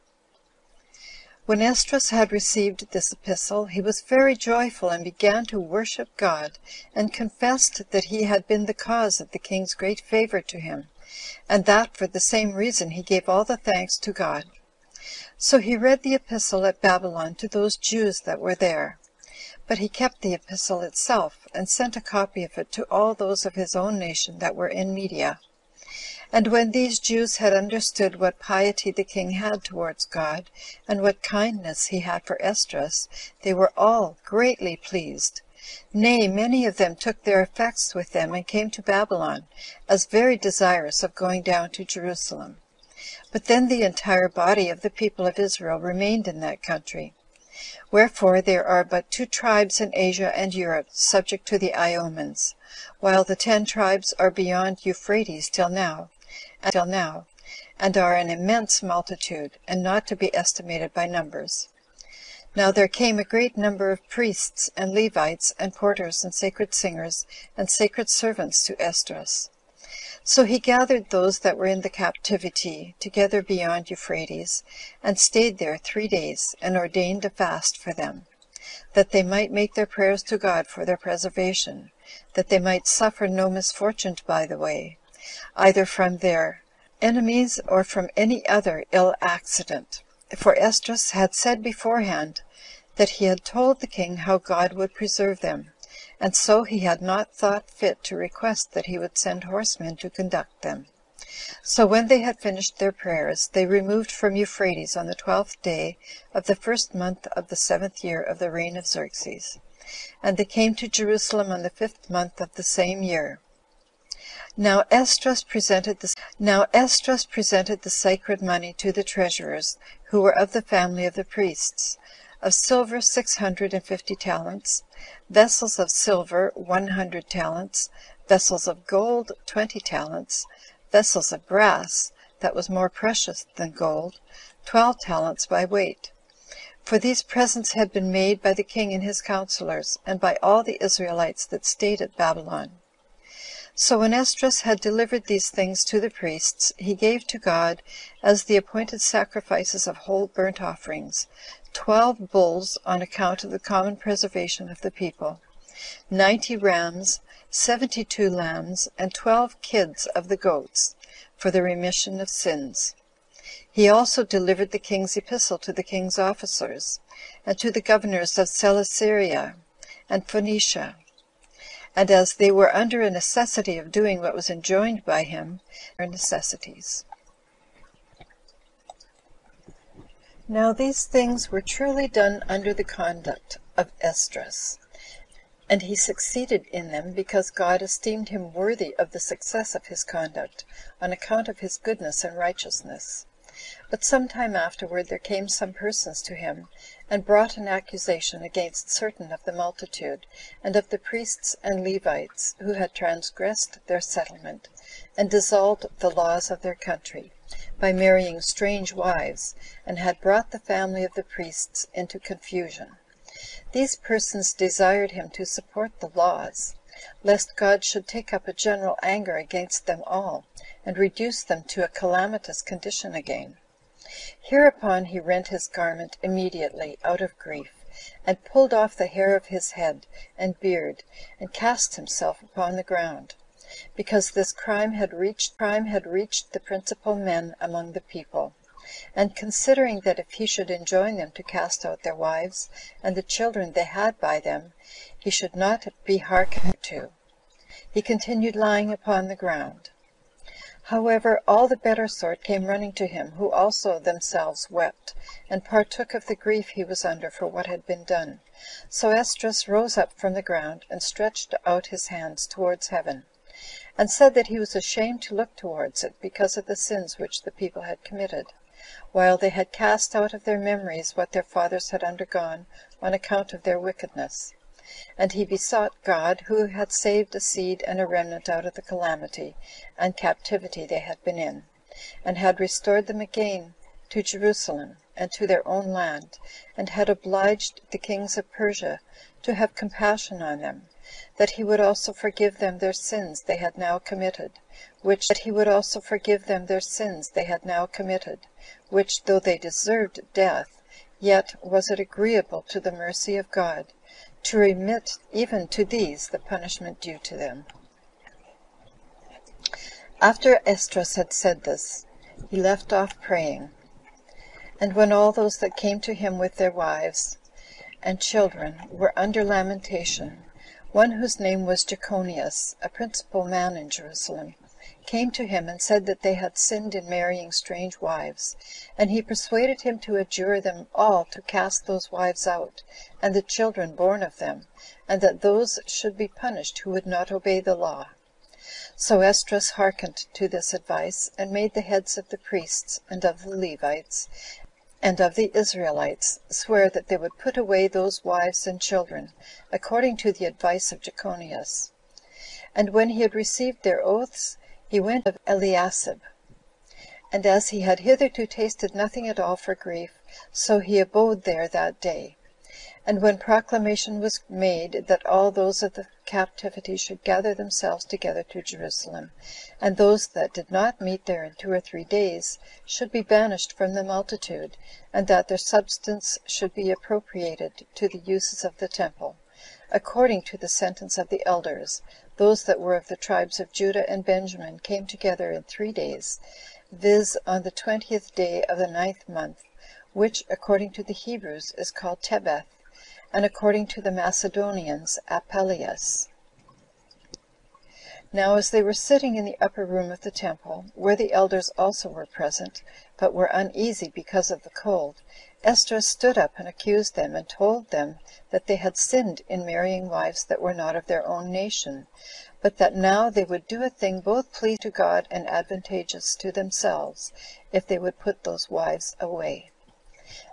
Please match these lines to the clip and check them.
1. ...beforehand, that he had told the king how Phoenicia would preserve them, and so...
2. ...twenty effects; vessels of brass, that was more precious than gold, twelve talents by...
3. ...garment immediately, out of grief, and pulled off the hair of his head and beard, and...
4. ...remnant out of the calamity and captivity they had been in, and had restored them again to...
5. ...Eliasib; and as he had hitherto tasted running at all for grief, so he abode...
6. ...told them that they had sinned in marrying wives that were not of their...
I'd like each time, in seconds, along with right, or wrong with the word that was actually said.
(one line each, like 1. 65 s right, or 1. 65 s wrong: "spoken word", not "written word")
1. 91 s wrong: "God", not "Phoenicia"
2. 129 s wrong: "talents", not "effects"
3. 225 s right
4. 278 s right
5. 355 s wrong: "nothing", not "running"
6. 407 s right.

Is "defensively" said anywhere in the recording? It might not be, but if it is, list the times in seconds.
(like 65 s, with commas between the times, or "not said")
not said.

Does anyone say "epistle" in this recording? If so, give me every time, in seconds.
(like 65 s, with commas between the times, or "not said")
3 s, 16 s, 20 s, 165 s.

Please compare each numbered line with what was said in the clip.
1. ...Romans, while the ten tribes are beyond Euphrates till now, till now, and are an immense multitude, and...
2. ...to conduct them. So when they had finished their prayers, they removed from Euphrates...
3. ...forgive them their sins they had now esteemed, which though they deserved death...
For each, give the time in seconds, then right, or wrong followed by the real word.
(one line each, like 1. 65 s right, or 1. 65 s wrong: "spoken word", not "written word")
1. 51 s right
2. 99 s right
3. 292 s wrong: "committed", not "esteemed".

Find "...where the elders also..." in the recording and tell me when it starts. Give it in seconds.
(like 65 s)
400 s.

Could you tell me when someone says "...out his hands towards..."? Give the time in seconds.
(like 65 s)
261 s.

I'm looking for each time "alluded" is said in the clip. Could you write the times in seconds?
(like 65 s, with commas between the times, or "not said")
not said.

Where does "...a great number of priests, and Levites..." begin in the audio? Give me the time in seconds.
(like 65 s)
63 s.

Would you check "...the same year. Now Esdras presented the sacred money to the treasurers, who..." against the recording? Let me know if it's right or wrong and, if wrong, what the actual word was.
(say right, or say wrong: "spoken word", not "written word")
right.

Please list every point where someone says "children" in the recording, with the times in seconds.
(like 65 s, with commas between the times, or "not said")
243 s, 318 s, 333 s, 348 s.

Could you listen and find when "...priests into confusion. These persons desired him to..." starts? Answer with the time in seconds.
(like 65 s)
211 s.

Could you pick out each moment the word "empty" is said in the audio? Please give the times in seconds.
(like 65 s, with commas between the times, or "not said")
not said.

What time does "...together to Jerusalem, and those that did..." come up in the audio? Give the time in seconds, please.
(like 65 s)
368 s.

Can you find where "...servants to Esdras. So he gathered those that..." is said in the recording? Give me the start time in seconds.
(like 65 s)
68 s.